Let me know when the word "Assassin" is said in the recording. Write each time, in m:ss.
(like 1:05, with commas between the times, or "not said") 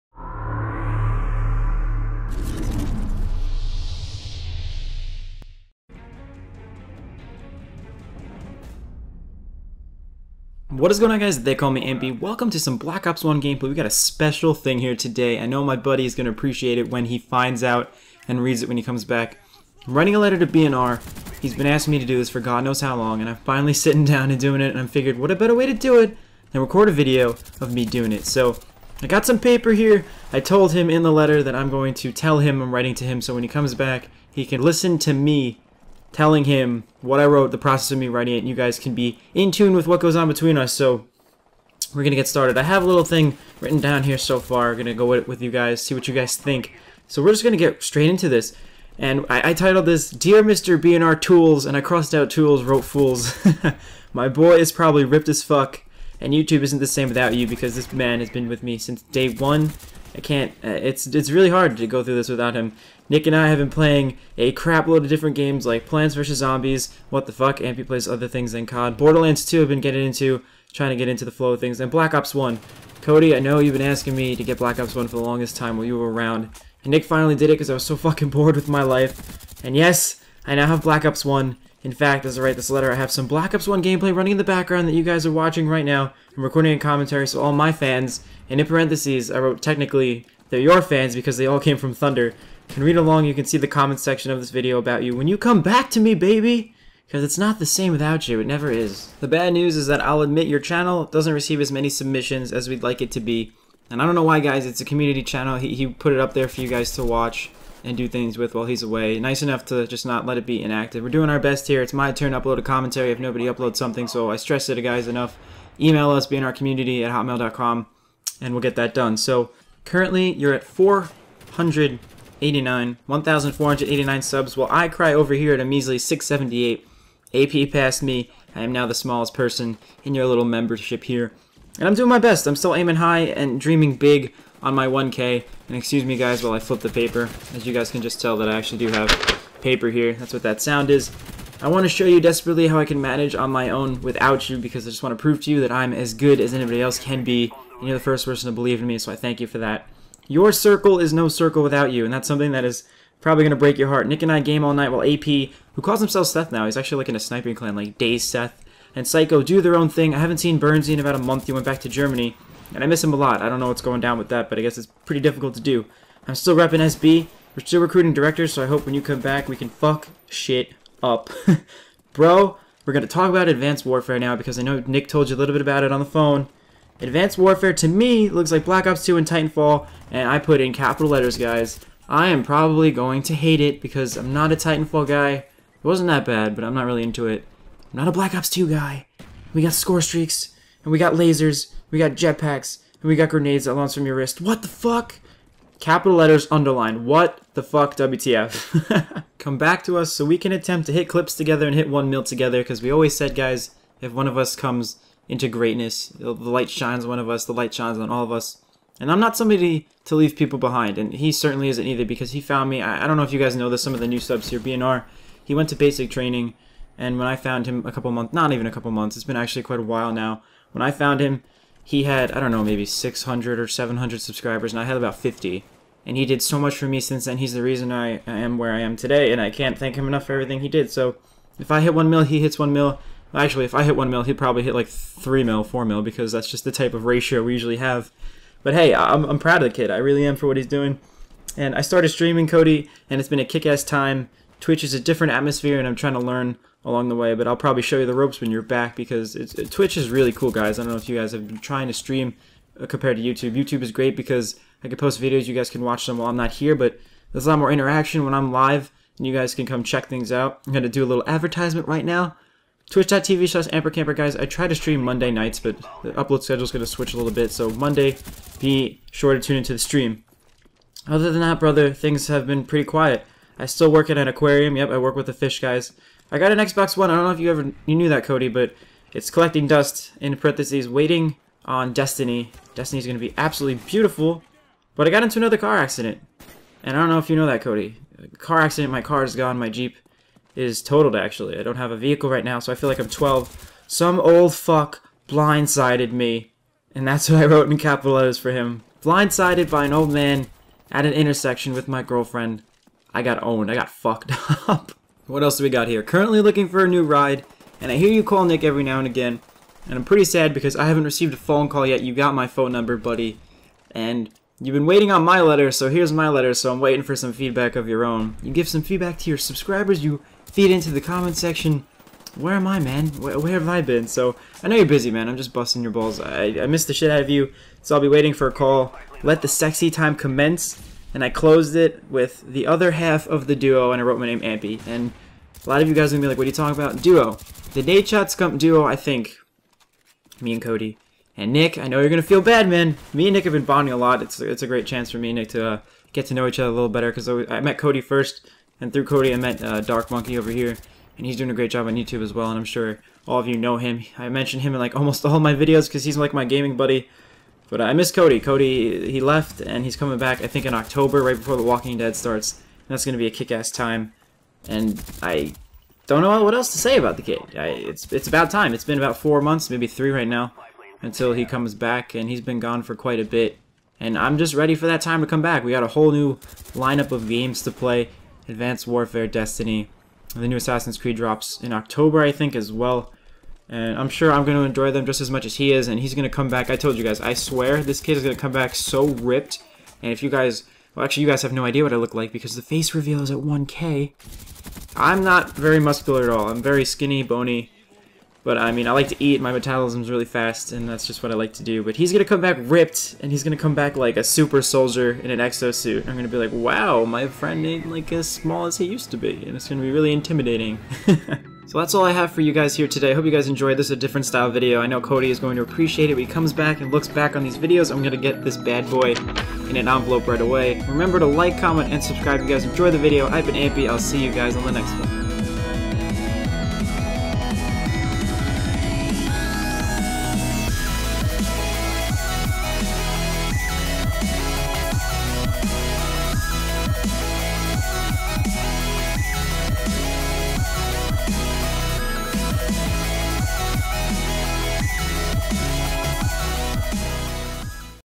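6:20.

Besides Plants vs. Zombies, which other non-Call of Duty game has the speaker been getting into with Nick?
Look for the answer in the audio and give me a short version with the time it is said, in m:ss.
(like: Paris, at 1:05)
Borderlands 2, at 1:08.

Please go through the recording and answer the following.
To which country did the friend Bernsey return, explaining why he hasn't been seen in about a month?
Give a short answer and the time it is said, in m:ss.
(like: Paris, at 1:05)
Germany, at 2:41.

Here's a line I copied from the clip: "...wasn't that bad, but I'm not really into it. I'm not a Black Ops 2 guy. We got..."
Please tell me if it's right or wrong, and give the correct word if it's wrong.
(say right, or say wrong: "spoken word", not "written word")
right.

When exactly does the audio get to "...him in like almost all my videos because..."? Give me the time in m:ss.
5:54.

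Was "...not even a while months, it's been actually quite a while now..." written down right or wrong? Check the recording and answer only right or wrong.
wrong.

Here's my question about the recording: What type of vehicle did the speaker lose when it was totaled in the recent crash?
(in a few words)
Jeep.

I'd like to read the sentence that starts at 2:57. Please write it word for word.
Advanced Warfare, to me, looks like Black Ops 2 and Titanfall, and I put in capital letters, guys.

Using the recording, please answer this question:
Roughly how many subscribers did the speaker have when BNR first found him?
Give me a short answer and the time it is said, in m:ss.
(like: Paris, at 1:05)
50, at 3:45.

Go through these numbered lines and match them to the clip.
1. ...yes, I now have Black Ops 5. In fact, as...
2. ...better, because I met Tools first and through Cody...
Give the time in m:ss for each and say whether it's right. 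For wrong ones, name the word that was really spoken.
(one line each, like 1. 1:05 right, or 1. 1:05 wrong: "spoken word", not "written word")
1. 1:19 wrong: "1", not "5"
2. 5:46 wrong: "Cody", not "Tools".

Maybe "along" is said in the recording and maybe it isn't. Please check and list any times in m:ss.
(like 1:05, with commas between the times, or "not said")
1:32, 4:06.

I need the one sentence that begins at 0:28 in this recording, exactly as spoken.
So, I got some paper here.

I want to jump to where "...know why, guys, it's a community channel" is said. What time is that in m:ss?
1:44.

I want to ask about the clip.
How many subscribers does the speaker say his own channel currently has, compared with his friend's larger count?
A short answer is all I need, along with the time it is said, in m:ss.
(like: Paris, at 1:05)
678, at 2:05.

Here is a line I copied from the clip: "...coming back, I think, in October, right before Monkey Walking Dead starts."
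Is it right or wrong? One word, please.
wrong.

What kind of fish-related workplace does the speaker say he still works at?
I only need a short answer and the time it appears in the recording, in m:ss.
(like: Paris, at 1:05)
An aquarium, at 4:34.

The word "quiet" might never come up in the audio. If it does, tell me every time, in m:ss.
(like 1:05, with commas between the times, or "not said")
4:32.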